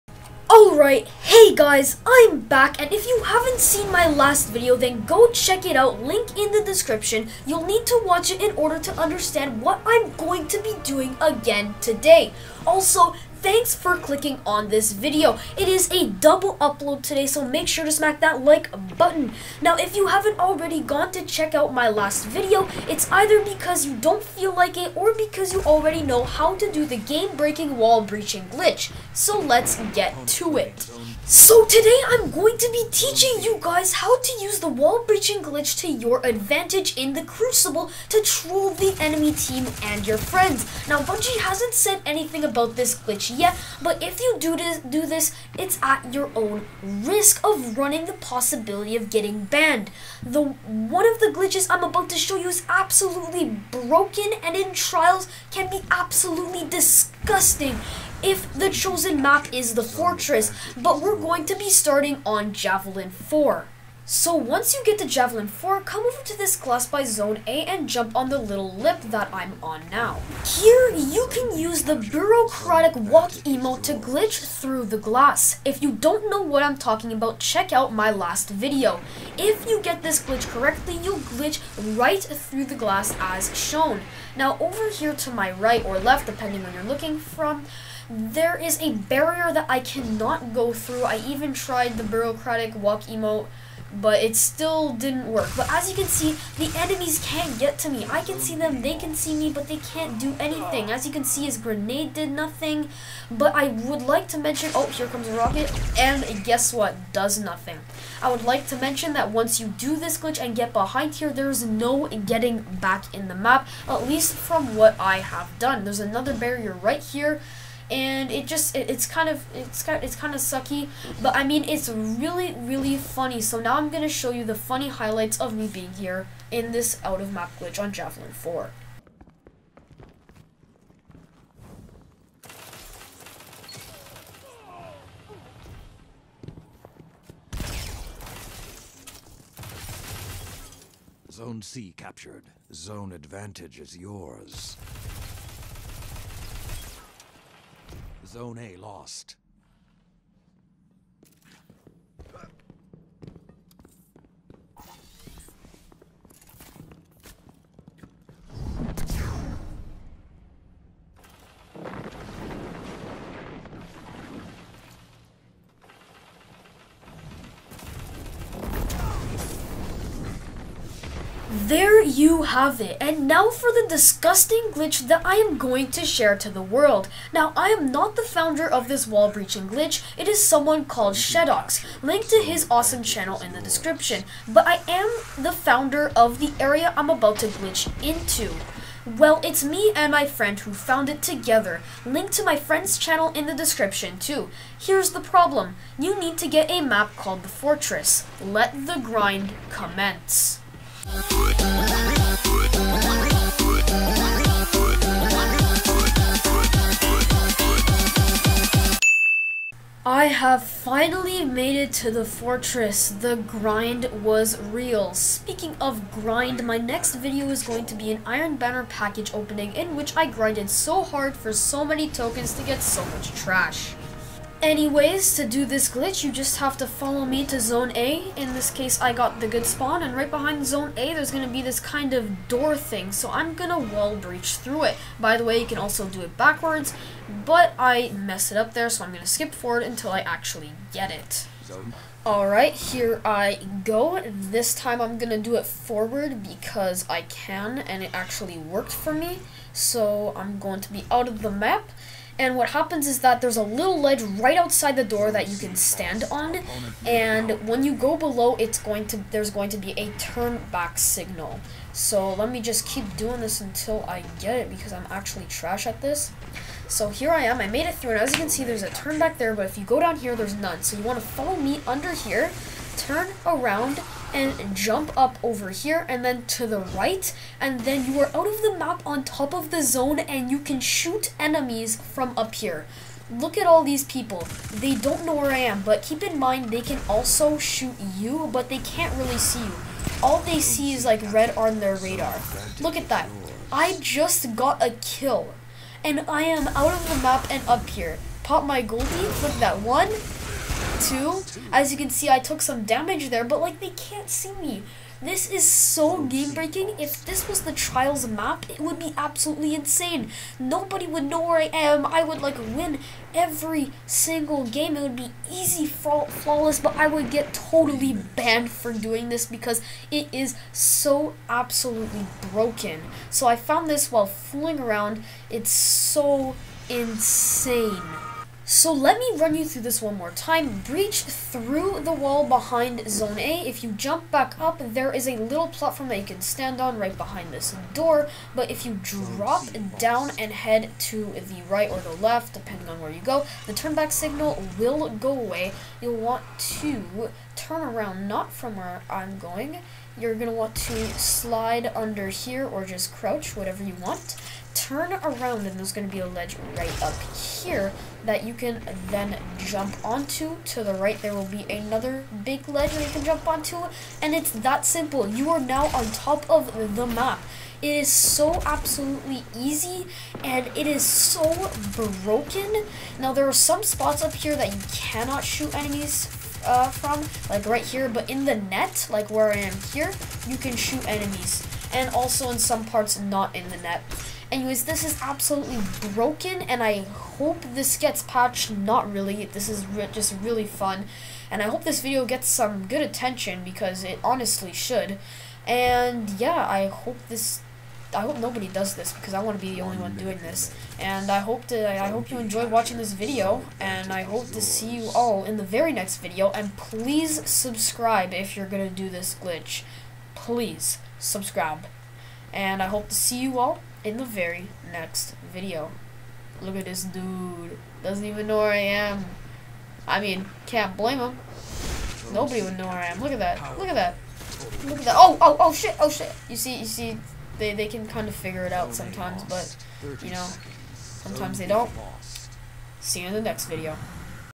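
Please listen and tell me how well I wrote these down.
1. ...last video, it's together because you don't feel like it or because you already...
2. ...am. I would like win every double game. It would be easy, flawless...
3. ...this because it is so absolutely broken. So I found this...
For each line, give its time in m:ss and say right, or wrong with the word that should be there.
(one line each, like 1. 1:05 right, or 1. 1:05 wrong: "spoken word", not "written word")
1. 0:21 wrong: "either", not "together"
2. 5:11 wrong: "single", not "double"
3. 5:19 right.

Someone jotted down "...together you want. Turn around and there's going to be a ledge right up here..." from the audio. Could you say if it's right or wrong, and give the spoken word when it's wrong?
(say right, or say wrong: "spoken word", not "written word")
wrong: "whatever", not "together".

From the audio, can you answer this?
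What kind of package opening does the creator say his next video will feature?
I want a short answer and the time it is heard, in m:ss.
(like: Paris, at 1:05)
Iron Banner, at 3:38.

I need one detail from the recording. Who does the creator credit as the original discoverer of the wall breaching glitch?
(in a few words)
Shedoxx.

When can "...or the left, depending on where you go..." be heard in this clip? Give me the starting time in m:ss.
5:41.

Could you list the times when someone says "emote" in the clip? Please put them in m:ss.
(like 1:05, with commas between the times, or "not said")
1:13, 1:33.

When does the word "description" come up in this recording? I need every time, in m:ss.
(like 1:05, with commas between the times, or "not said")
0:06, 3:03, 3:13.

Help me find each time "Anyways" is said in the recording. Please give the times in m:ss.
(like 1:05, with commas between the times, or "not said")
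3:44, 6:24.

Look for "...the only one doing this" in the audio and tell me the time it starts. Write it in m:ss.
6:39.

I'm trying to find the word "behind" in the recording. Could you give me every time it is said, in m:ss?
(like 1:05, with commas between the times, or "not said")
1:50, 3:50, 5:32, 5:37.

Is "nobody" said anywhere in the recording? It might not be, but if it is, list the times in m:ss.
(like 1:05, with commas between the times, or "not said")
5:10, 6:38, 7:02.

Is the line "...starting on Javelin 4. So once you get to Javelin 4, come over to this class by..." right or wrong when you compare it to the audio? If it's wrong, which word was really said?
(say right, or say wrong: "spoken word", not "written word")
right.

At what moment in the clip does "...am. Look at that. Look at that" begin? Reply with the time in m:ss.
7:03.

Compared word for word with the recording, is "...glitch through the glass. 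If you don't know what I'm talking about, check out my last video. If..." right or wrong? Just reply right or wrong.
right.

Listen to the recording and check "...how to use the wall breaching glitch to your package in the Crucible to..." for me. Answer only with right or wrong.
wrong.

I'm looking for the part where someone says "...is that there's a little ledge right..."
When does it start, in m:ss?
4:13.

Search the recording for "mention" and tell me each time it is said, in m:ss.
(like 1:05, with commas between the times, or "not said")
1:44, 1:48.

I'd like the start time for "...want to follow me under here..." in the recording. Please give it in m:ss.
4:31.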